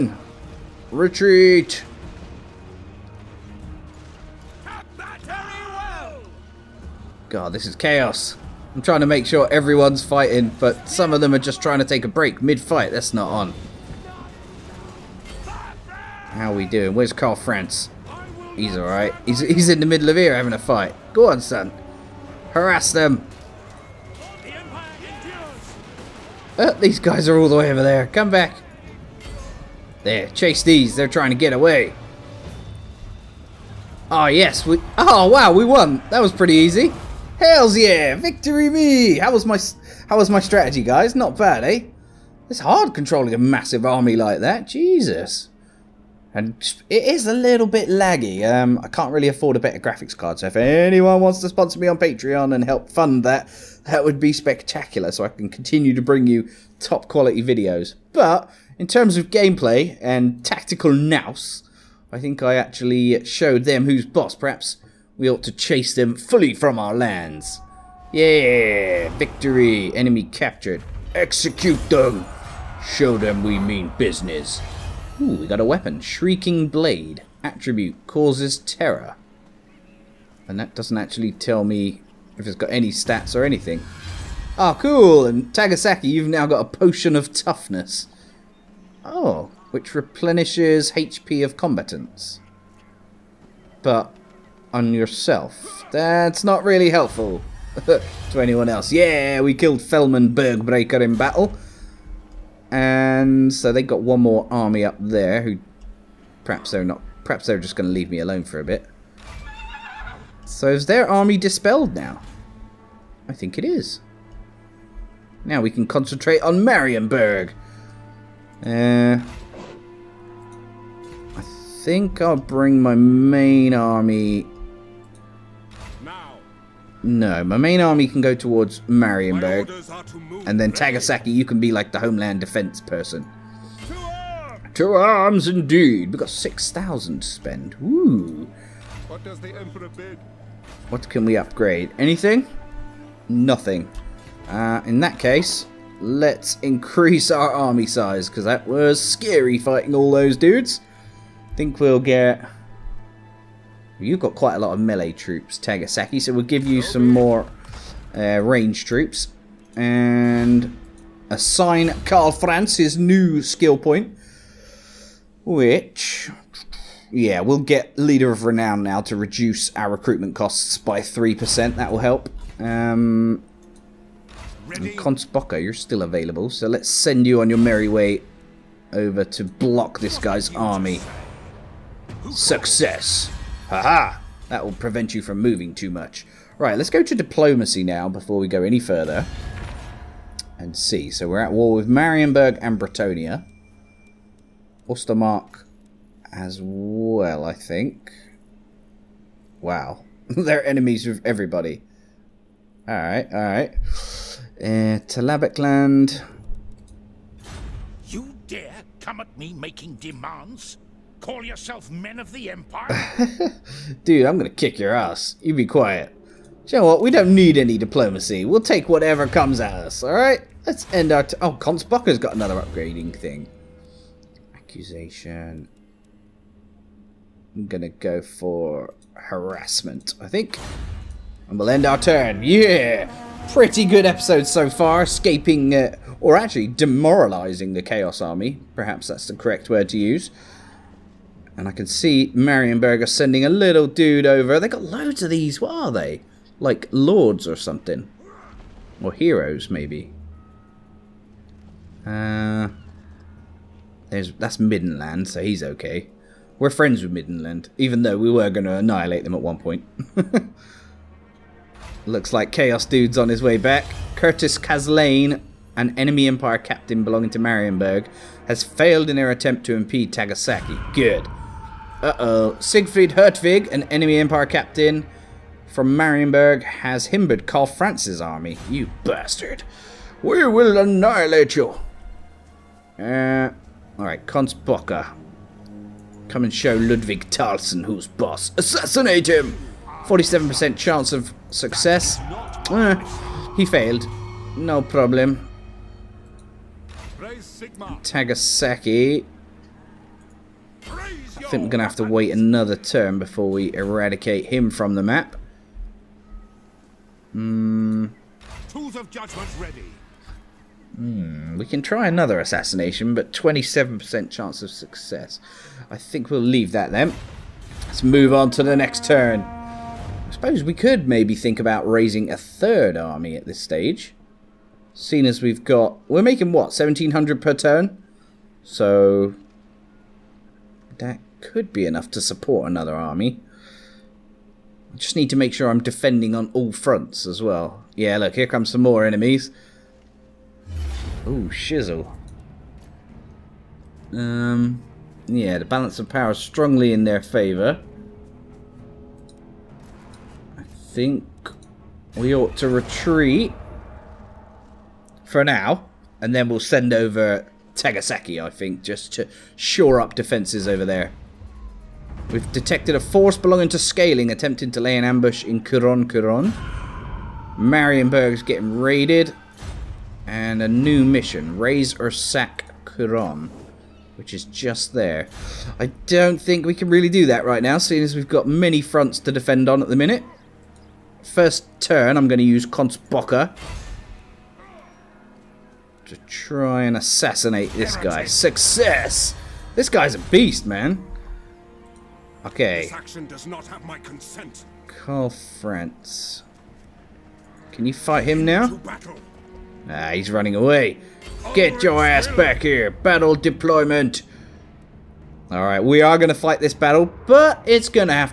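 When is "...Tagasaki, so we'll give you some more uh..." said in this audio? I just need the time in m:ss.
2:35.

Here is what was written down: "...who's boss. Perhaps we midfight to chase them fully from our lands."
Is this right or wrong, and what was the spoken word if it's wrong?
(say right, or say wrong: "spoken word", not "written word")
wrong: "ought", not "midfight".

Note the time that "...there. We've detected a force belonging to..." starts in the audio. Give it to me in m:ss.
6:00.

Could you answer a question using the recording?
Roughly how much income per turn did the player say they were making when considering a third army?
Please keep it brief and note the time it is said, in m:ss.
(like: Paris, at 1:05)
1,700, at 5:26.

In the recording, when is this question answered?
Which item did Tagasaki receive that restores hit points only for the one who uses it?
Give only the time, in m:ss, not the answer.
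1:26.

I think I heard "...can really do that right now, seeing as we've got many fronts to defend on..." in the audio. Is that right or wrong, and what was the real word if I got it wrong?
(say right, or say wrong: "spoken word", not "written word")
right.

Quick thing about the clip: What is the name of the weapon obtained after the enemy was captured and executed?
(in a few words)
Shrieking Blade.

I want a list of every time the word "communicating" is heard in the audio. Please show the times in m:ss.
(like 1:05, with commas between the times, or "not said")
not said.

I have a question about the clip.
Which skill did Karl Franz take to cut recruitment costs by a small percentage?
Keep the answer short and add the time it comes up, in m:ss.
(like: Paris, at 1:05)
Leader of Renown, at 2:47.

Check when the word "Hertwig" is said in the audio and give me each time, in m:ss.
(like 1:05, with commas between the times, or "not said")
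4:33.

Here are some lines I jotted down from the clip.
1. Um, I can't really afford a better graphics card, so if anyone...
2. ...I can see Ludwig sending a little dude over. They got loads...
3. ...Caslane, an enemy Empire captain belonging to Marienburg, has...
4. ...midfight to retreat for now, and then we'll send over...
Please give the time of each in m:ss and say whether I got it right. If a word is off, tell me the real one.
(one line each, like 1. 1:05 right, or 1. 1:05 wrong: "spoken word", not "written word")
1. 0:48 right
2. 4:01 wrong: "Marienberger", not "Ludwig"
3. 4:24 right
4. 5:52 wrong: "ought", not "midfight".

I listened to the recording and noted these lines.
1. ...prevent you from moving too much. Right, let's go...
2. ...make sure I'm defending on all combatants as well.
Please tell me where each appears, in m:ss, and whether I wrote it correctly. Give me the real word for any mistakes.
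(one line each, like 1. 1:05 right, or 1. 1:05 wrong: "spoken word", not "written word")
1. 3:04 right
2. 5:35 wrong: "fronts", not "combatants".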